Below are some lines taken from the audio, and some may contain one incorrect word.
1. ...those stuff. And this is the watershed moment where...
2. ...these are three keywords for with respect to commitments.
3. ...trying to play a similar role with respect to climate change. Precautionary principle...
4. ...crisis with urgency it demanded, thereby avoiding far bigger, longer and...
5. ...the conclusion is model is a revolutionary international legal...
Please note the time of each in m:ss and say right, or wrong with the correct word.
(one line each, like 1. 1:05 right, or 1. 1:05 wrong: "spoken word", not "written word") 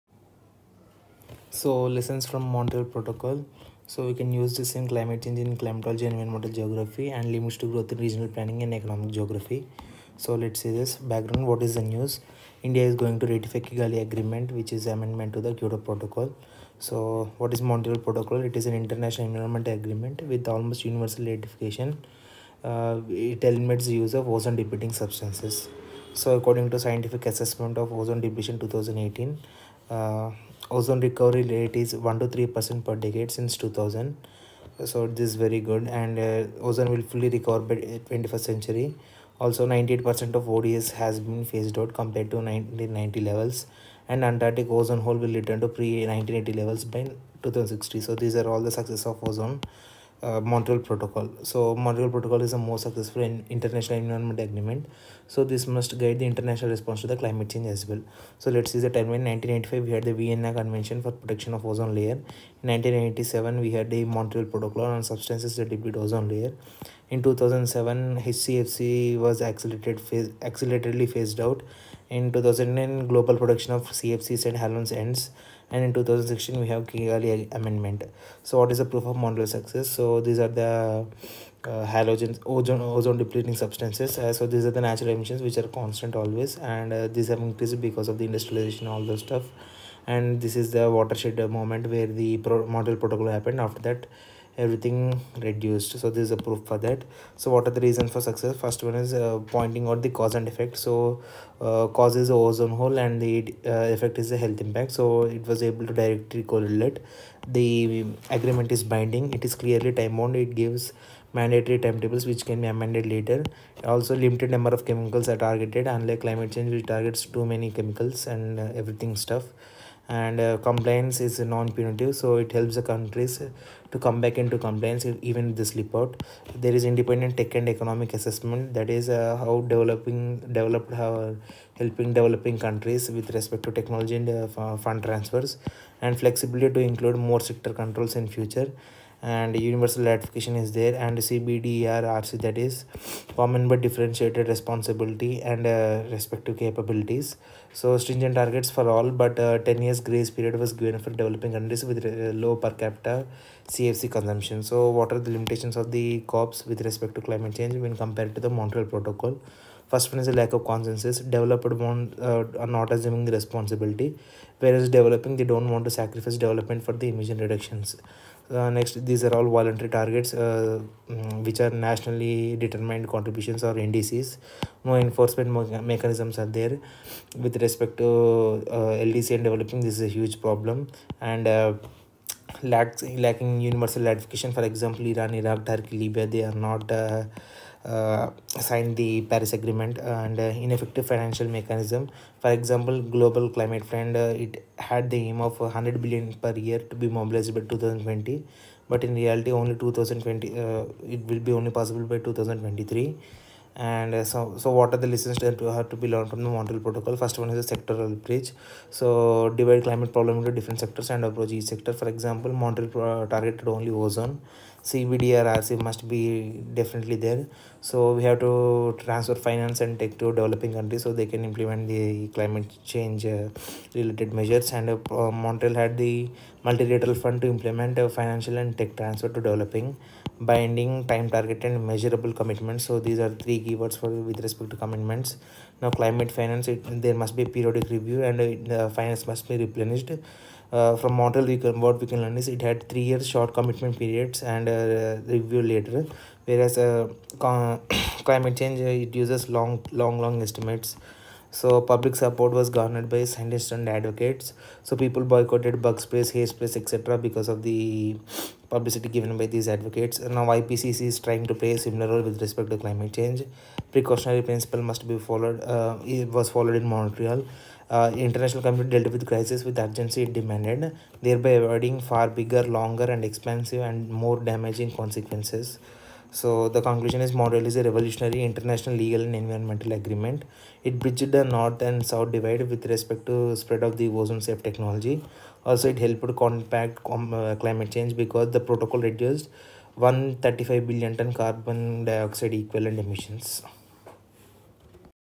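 1. 1:29 right
2. 3:52 right
3. 4:21 right
4. 4:29 right
5. 4:36 right.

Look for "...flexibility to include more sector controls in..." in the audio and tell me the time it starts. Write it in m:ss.
2:16.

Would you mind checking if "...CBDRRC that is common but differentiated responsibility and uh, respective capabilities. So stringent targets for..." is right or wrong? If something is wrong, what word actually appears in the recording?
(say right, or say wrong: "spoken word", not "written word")
right.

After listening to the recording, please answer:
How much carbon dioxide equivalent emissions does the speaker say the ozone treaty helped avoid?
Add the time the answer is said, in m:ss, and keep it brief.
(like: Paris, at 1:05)
135 billion tons, at 4:49.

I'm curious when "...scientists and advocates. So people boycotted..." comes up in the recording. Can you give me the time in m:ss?
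4:13.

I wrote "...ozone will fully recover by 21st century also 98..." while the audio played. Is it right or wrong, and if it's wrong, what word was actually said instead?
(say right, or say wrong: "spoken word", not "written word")
right.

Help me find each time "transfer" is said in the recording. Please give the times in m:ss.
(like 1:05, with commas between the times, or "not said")
2:15, 3:38, 3:48.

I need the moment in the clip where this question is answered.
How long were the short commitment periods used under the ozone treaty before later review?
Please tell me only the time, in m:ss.
4:02.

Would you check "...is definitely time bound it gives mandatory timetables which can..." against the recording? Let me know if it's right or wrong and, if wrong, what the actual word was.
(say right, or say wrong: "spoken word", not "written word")
wrong: "clearly", not "definitely".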